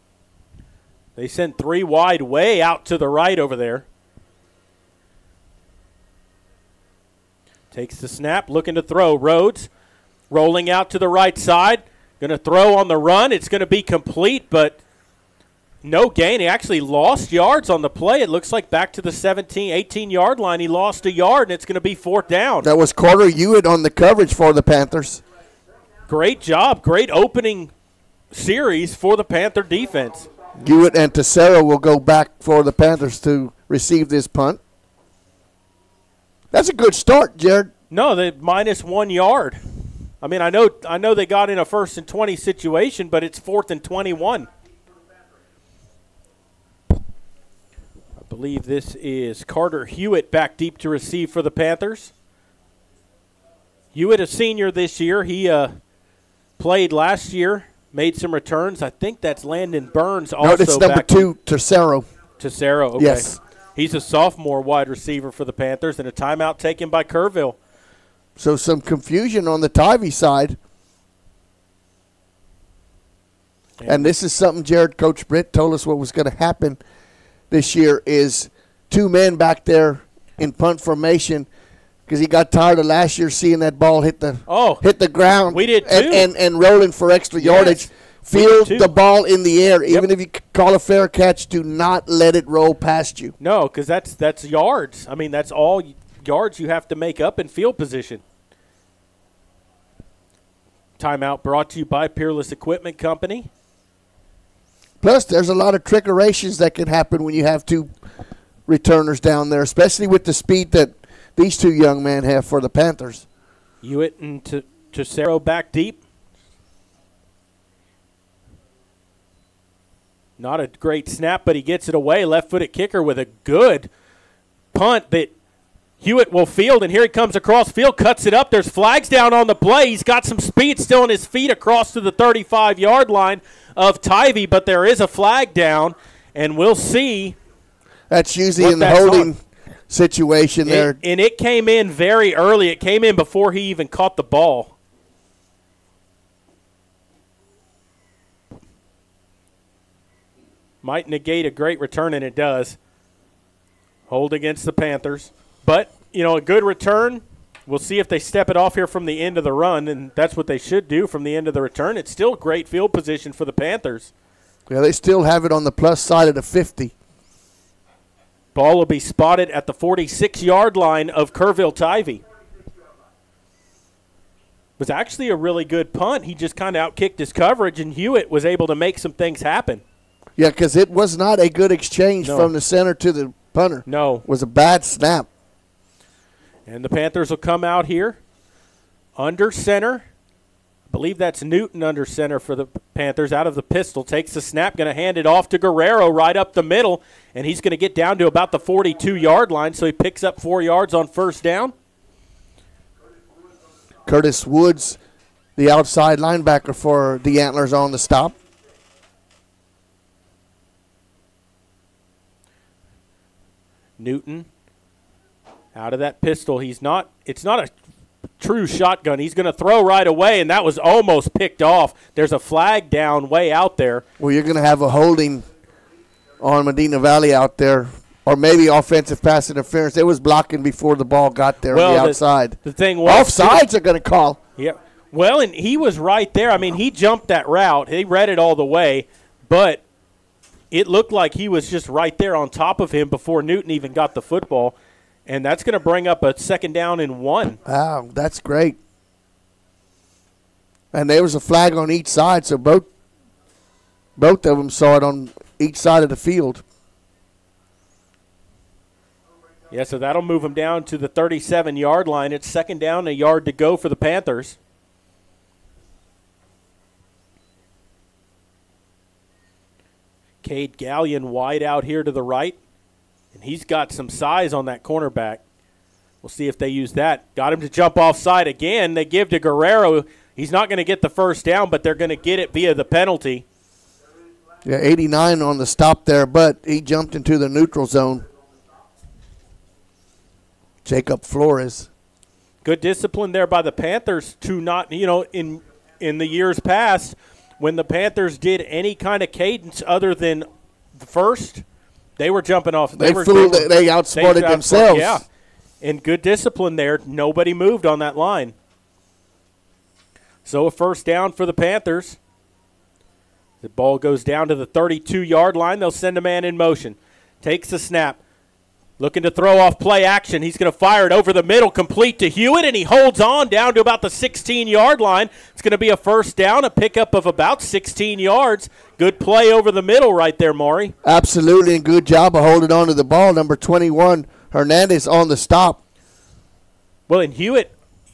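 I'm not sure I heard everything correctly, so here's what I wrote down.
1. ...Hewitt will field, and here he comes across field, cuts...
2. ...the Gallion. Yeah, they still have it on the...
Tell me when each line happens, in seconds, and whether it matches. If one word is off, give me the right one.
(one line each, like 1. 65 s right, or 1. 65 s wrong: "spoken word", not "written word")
1. 125 s right
2. 163 s wrong: "Panthers", not "Gallion".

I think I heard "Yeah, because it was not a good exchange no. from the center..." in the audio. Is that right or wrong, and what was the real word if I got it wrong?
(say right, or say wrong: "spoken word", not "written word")
right.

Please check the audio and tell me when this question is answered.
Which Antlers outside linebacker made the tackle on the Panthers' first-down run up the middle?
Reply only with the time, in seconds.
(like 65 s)
204 s.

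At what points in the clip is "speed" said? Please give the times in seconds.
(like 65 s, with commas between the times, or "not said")
110 s, 130 s.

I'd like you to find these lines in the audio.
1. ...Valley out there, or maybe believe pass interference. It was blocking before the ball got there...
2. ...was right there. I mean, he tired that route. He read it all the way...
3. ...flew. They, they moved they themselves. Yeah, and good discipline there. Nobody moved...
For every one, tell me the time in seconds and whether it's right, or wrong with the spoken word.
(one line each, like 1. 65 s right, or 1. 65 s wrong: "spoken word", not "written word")
1. 226 s wrong: "offensive", not "believe"
2. 235 s wrong: "jumped", not "tired"
3. 303 s wrong: "outsmarted", not "moved".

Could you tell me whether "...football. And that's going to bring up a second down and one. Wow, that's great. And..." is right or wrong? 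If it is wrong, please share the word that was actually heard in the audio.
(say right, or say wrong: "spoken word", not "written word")
right.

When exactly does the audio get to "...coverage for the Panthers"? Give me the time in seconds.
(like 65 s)
23 s.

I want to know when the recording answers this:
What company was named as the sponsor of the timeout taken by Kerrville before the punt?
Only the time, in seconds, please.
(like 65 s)
102 s.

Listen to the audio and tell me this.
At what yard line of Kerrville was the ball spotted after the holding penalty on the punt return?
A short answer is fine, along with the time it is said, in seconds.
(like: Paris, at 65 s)
46, at 169 s.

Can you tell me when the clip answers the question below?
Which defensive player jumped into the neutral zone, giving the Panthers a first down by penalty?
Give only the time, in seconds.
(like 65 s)
290 s.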